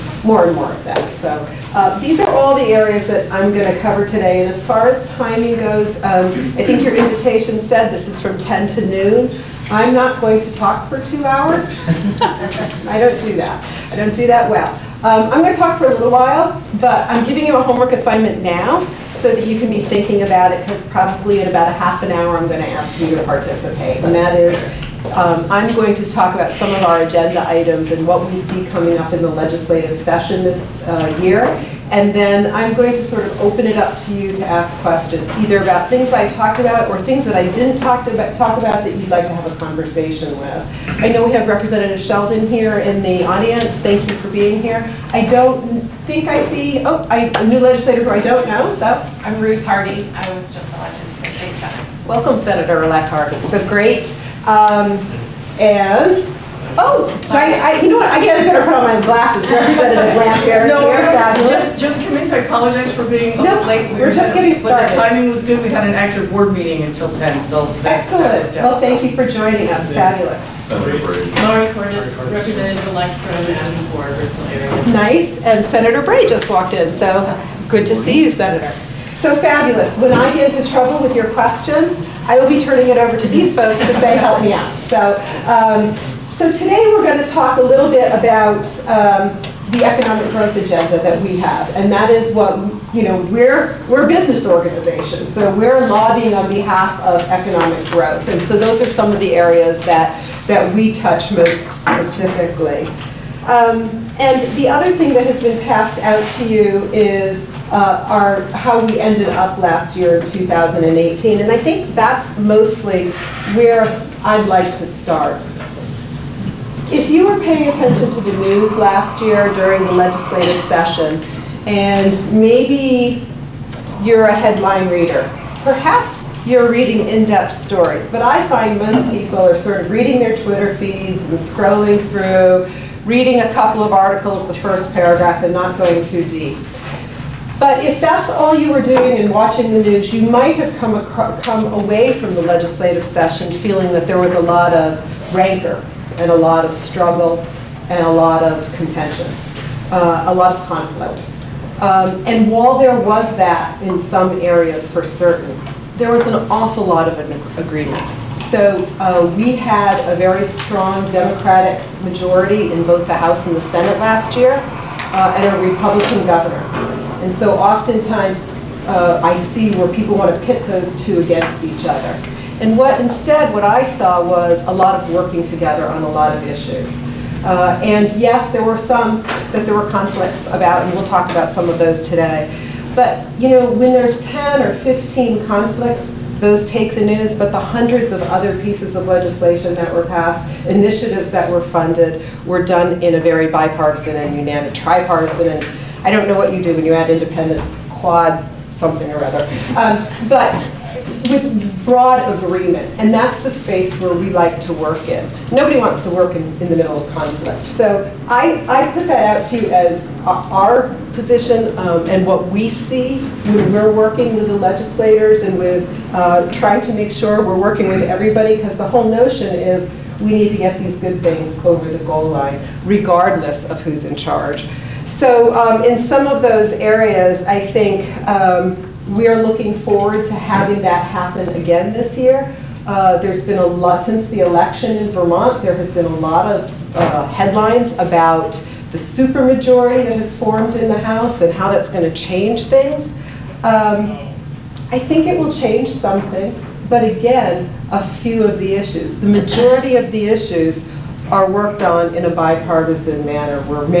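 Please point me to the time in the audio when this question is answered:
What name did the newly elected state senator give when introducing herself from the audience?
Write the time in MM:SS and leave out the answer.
00:49.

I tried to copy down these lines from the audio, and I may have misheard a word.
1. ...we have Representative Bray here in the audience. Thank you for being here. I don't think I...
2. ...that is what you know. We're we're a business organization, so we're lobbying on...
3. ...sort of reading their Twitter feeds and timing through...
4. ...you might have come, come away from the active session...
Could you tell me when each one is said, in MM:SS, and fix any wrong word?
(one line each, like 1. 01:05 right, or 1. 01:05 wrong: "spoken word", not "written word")
1. 00:41 wrong: "Sheldon", not "Bray"
2. 01:31 right
3. 02:09 wrong: "scrolling", not "timing"
4. 02:20 wrong: "legislative", not "active".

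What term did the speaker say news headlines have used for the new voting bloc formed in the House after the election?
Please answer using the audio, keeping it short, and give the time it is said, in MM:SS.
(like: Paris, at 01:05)
supermajority, at 03:58.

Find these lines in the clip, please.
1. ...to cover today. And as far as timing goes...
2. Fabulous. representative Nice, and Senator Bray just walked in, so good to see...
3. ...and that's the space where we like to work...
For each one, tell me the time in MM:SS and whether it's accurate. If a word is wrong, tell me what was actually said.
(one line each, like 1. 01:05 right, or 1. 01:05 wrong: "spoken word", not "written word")
1. 00:03 right
2. 01:09 right
3. 03:22 right.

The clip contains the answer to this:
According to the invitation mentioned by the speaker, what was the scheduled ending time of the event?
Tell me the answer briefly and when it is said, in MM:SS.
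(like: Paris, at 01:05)
noon, at 00:08.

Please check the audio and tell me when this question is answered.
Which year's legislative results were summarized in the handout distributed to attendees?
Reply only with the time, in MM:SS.
01:50.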